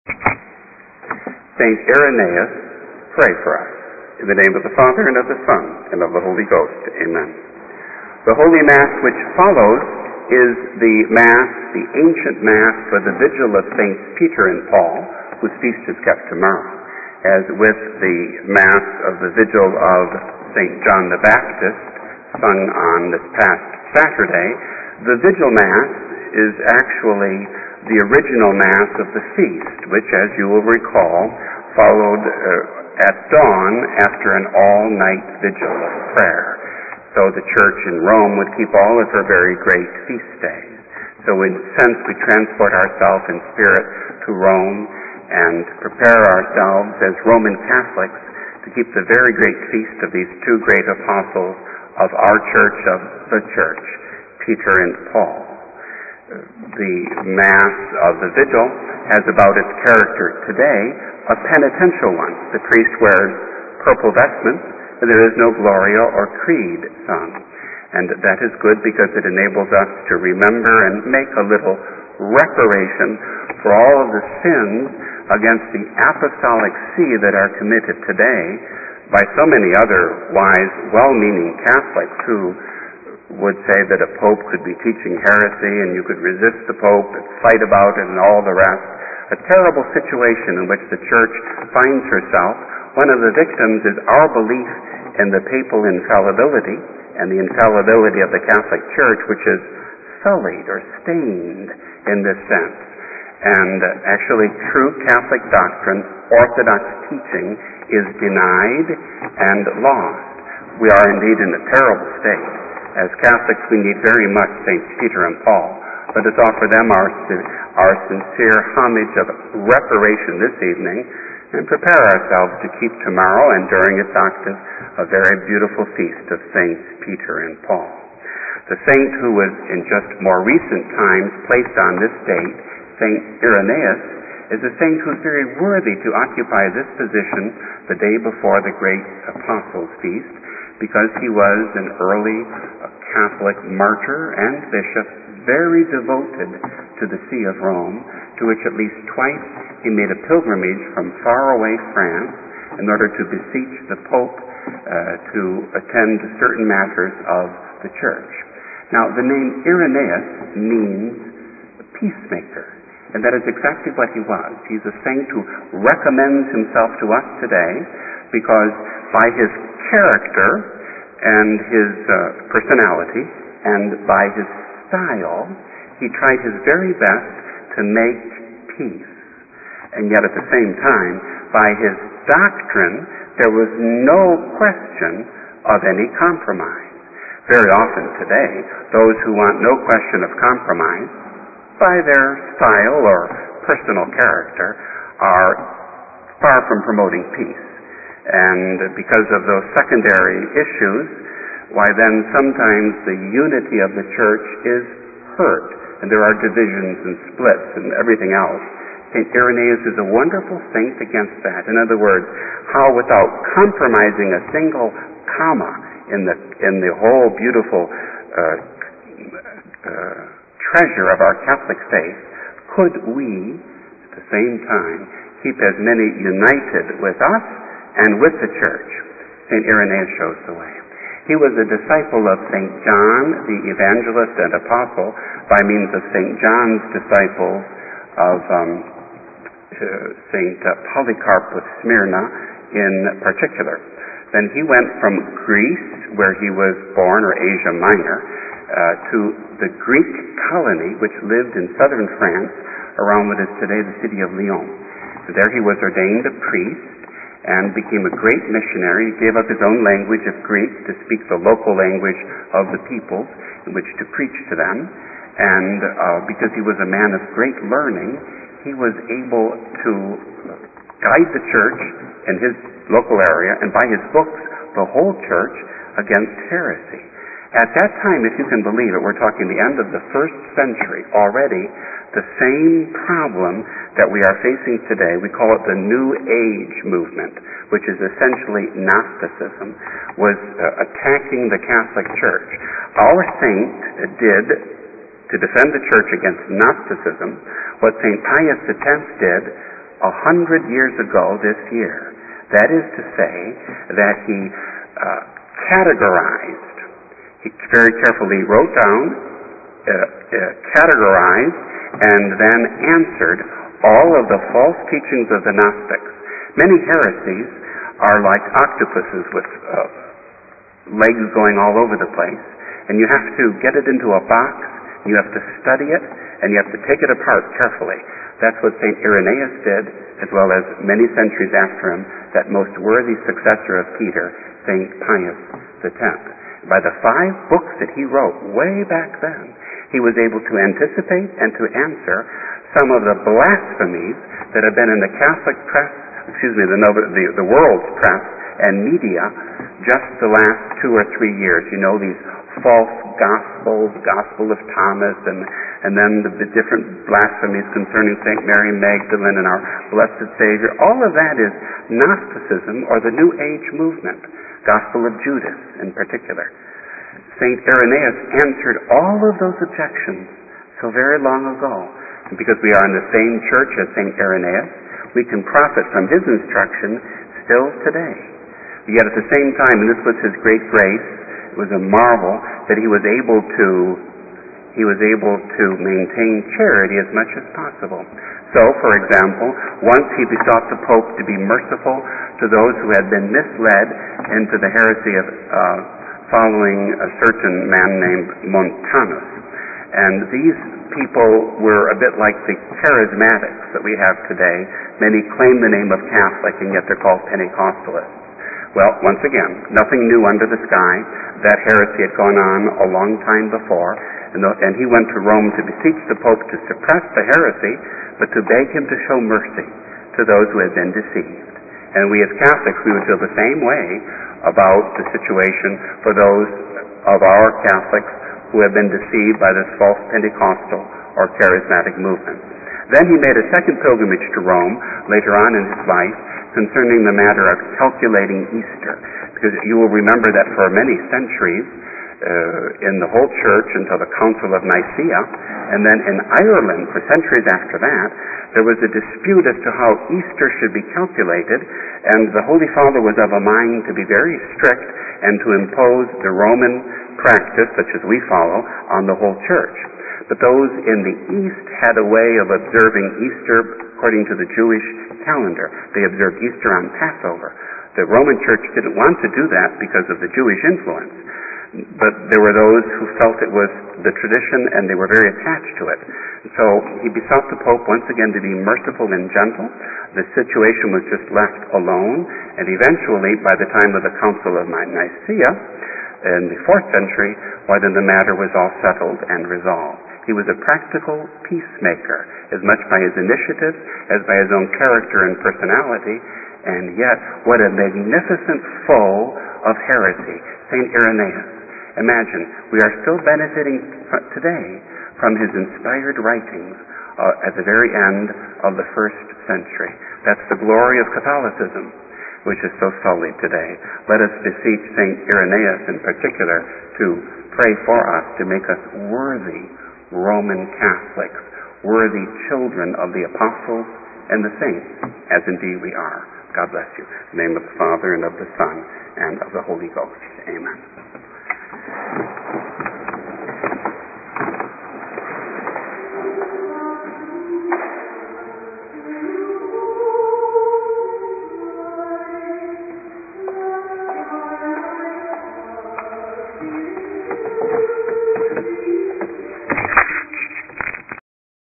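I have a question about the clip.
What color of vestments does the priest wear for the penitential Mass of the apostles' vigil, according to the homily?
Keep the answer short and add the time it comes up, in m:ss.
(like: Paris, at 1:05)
Purple, at 1:03.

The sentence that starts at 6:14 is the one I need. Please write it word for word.
Irenaeus, we can profit from his instruction still today.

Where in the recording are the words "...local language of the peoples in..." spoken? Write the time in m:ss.
4:21.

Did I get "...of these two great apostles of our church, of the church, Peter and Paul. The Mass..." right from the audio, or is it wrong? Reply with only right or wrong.
right.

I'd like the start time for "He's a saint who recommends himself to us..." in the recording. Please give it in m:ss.
2:44.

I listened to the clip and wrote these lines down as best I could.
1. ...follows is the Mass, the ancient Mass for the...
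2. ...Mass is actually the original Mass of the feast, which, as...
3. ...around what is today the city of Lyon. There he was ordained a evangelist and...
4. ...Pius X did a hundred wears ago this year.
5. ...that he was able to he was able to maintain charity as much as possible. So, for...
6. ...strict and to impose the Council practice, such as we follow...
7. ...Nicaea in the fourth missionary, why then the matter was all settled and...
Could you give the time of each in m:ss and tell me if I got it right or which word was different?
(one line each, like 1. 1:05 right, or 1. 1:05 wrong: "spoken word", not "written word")
1. 0:09 right
2. 0:25 right
3. 4:12 wrong: "priest", not "evangelist"
4. 4:58 wrong: "years", not "wears"
5. 6:22 right
6. 7:34 wrong: "Roman", not "Council"
7. 8:04 wrong: "century", not "missionary".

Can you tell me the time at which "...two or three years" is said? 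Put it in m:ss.
5:50.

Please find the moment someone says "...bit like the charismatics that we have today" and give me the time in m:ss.
6:41.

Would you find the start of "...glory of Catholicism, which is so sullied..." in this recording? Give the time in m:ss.
8:30.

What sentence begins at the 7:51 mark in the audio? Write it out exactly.
But there were those who felt it was the tradition and they were very attached to it.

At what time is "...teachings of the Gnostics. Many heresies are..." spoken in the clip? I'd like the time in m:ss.
5:14.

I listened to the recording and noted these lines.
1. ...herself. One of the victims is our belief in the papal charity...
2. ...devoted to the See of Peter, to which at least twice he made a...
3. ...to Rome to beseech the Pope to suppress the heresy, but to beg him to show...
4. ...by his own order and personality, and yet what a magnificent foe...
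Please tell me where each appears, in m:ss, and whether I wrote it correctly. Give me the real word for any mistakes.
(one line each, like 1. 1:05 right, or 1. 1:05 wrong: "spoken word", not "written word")
1. 1:32 wrong: "infallibility", not "charity"
2. 2:25 wrong: "Rome", not "Peter"
3. 6:55 right
4. 8:14 wrong: "character", not "order".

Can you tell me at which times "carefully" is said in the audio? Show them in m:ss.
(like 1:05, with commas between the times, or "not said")
5:08, 5:27.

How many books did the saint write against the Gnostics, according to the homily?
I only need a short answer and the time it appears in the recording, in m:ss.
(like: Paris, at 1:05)
5, at 5:37.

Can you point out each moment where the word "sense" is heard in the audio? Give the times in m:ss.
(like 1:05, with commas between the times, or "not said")
0:41, 1:42.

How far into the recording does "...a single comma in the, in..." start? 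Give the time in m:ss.
3:34.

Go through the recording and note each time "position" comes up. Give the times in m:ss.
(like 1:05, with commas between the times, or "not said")
2:16.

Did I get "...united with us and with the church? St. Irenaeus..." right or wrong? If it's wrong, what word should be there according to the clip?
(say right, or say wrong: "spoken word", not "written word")
right.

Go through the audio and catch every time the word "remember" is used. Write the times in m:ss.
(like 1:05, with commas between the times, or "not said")
1:10, 7:19.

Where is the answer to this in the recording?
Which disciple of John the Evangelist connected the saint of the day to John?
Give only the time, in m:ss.
4:00.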